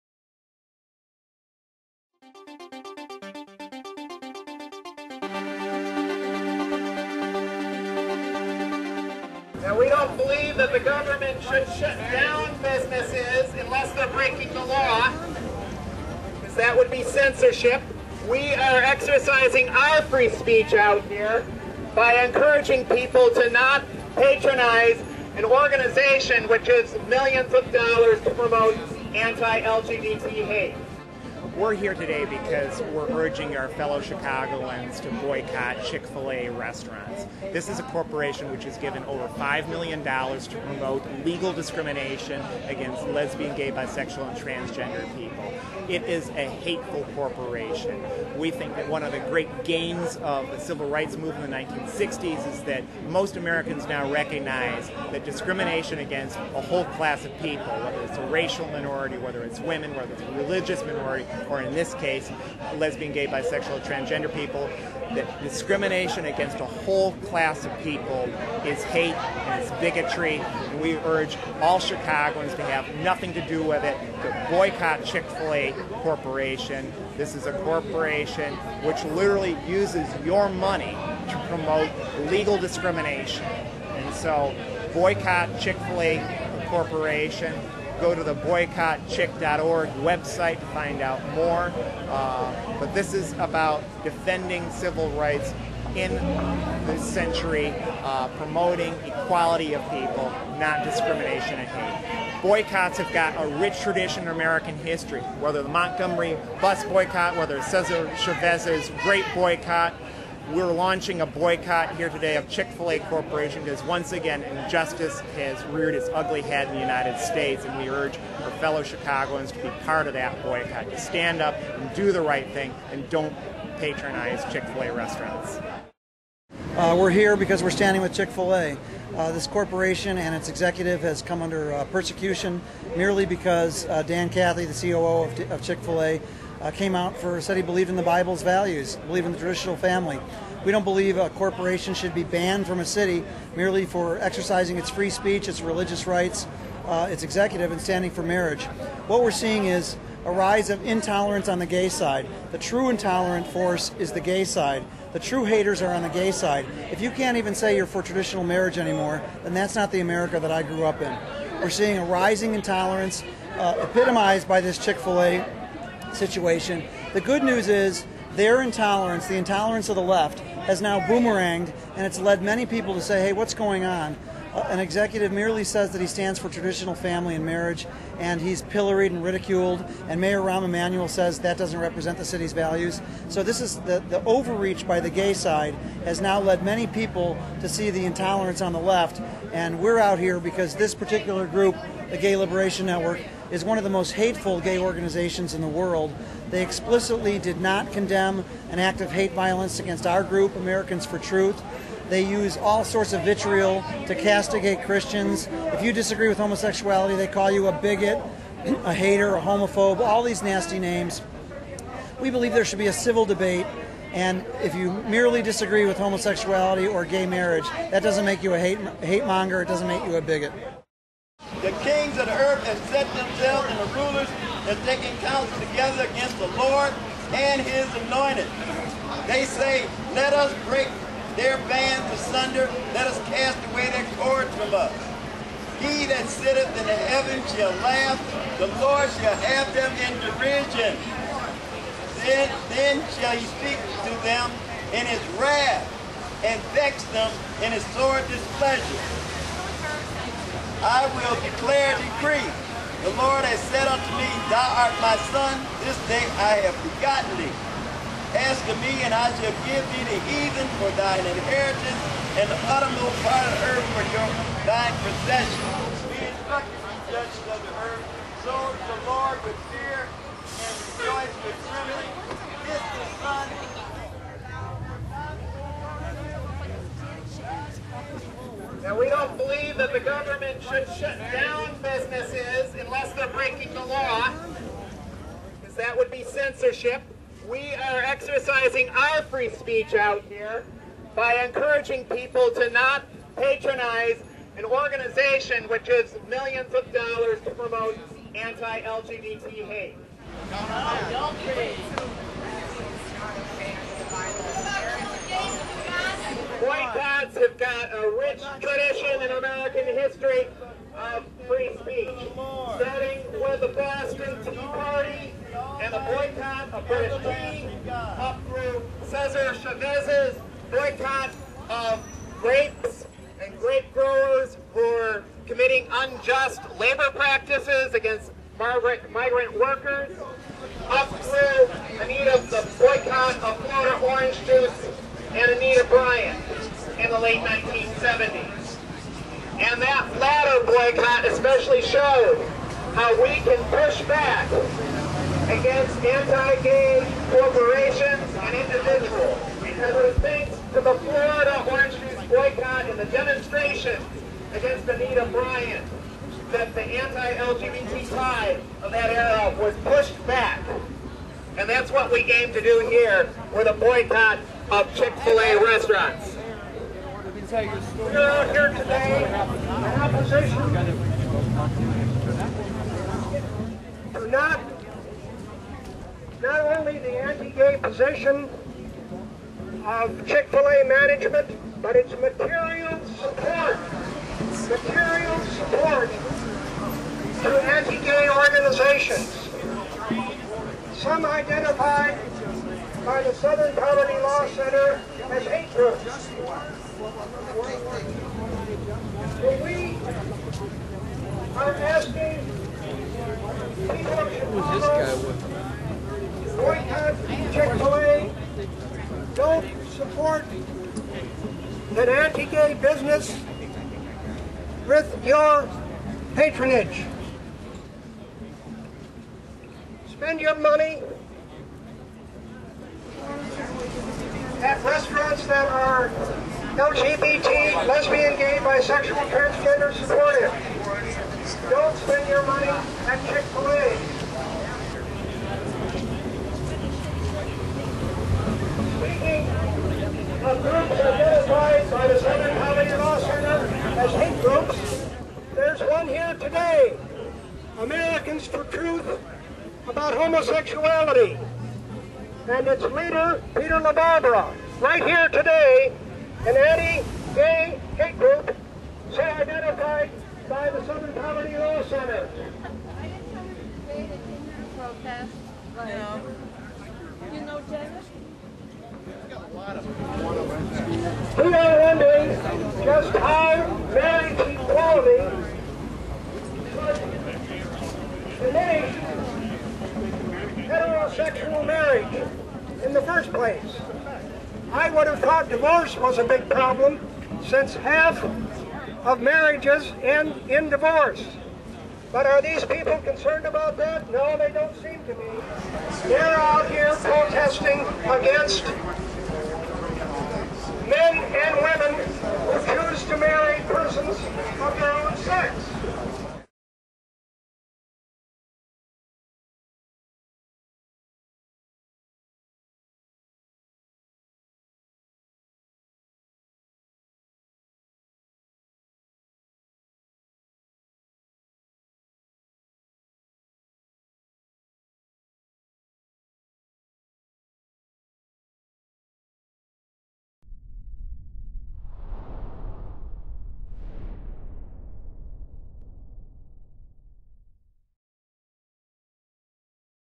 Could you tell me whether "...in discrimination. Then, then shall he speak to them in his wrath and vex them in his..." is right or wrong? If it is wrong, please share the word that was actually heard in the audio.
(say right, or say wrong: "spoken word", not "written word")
wrong: "derision", not "discrimination".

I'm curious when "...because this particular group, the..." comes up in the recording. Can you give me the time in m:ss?
3:10.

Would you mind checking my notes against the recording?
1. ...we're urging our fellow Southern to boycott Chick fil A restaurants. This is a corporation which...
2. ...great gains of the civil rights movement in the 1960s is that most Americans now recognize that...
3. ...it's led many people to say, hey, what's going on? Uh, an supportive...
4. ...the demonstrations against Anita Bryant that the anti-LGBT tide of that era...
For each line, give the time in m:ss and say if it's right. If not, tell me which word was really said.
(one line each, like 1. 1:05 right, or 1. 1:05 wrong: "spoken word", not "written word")
1. 0:32 wrong: "Chicagoans", not "Southern"
2. 0:49 right
3. 2:52 wrong: "executive", not "supportive"
4. 5:52 right.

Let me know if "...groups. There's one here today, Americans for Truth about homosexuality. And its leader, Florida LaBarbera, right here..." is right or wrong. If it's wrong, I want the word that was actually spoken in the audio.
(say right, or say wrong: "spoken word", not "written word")
wrong: "Peter", not "Florida".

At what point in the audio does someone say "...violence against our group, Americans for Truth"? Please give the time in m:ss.
3:19.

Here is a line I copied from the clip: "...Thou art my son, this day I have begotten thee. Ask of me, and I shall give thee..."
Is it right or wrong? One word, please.
right.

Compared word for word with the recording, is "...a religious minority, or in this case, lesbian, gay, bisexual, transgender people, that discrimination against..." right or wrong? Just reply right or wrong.
right.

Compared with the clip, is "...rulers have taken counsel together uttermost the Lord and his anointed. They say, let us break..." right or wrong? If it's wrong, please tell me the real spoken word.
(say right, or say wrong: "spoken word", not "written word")
wrong: "against", not "uttermost".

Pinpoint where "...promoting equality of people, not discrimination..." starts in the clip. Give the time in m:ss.
1:38.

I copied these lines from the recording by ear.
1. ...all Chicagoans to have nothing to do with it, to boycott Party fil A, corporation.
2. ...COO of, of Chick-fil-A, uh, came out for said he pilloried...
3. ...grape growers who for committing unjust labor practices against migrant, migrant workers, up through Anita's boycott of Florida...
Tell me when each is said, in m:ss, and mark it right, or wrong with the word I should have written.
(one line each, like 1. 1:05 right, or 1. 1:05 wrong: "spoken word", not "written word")
1. 1:11 wrong: "Chick", not "Party"
2. 2:14 wrong: "believed", not "pilloried"
3. 5:23 right.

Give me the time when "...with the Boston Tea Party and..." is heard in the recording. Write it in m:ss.
5:13.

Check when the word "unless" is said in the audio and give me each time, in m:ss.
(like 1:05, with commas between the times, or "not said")
0:13, 4:42.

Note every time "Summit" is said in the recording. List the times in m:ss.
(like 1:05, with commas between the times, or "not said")
not said.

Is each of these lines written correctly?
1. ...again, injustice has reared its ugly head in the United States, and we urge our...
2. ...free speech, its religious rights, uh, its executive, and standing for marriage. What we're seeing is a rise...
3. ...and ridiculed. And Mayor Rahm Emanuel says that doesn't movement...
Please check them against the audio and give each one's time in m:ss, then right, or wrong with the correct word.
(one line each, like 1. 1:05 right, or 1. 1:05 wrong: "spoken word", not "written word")
1. 1:54 right
2. 2:24 right
3. 2:59 wrong: "represent", not "movement".